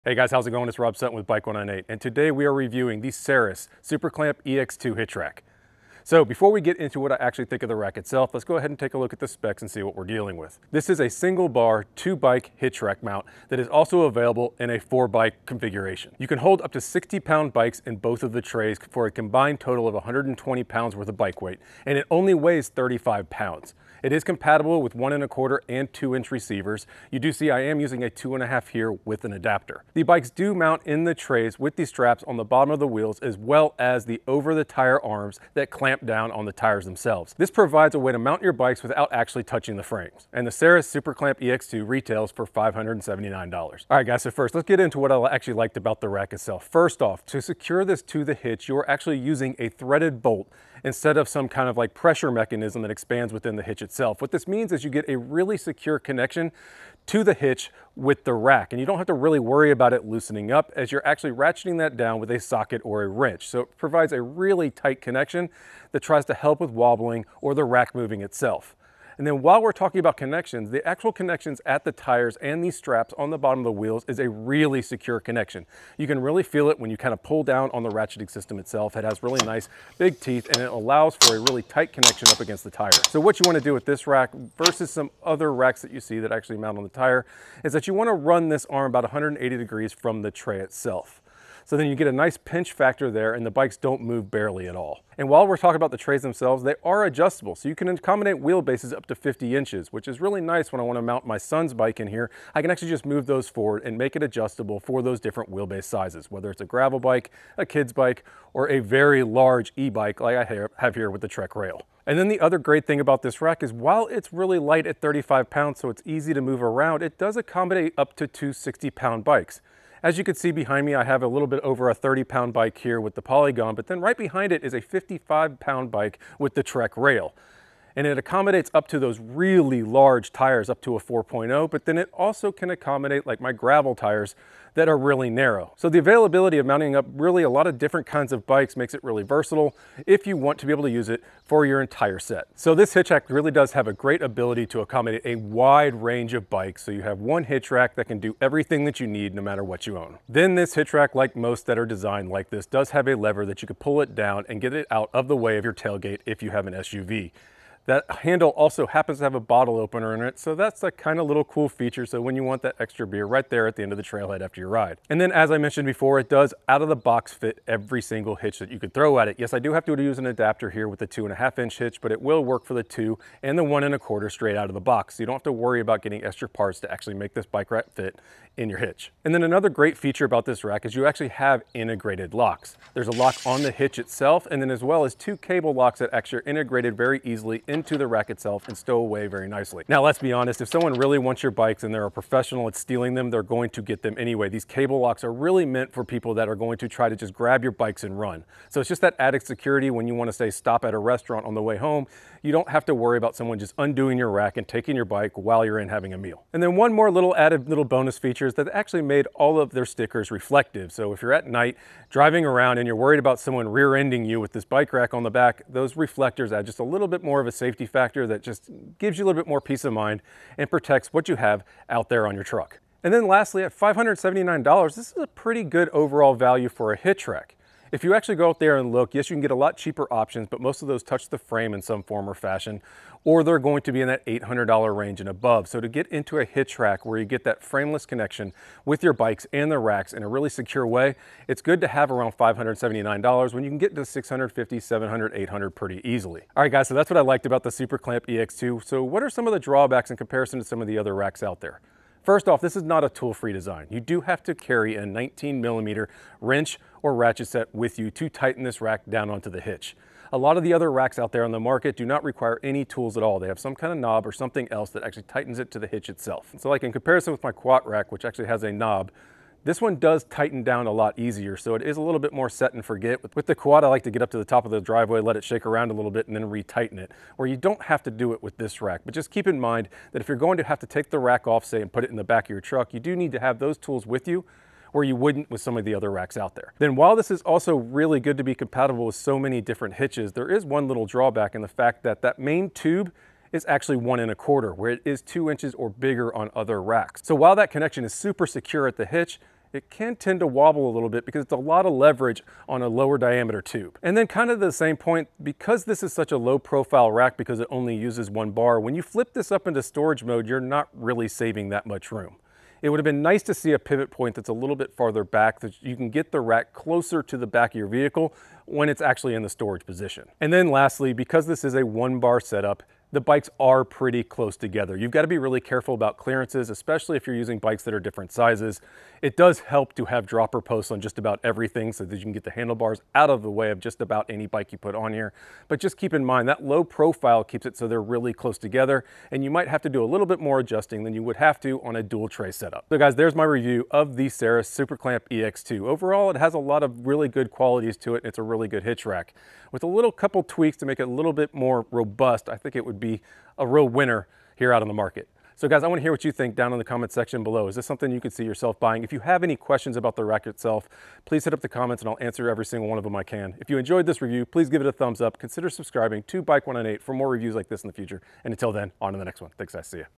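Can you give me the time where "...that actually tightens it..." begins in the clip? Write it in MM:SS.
04:24.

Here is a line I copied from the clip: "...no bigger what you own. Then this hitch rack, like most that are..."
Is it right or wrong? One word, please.
wrong.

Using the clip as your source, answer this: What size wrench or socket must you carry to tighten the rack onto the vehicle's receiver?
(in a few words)
19 millimeter.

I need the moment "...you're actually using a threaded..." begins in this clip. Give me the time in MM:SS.
00:48.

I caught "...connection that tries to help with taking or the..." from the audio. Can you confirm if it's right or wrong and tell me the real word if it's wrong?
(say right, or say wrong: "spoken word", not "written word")
wrong: "wobbling", not "taking".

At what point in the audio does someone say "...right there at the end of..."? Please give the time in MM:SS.
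02:43.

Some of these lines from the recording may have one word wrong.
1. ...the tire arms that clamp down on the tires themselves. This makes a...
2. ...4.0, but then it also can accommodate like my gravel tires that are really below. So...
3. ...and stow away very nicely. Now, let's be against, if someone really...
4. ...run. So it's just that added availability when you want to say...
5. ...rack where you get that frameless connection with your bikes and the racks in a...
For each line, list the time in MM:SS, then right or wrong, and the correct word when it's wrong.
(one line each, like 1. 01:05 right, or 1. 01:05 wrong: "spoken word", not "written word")
1. 00:34 wrong: "provides", not "makes"
2. 02:10 wrong: "narrow", not "below"
3. 03:08 wrong: "honest", not "against"
4. 03:18 wrong: "security", not "availability"
5. 03:56 right.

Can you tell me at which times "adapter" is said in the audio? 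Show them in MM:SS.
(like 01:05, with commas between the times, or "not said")
00:29, 02:50.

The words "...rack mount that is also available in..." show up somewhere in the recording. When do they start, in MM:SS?
00:12.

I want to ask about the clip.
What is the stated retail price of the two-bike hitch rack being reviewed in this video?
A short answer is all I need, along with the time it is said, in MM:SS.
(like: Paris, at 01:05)
$579, at 00:41.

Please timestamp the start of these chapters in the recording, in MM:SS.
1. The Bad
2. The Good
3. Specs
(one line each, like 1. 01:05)
1. 04:06
2. 00:43
3. 00:10.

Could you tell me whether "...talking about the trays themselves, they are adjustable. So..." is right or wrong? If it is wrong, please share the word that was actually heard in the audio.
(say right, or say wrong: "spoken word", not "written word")
right.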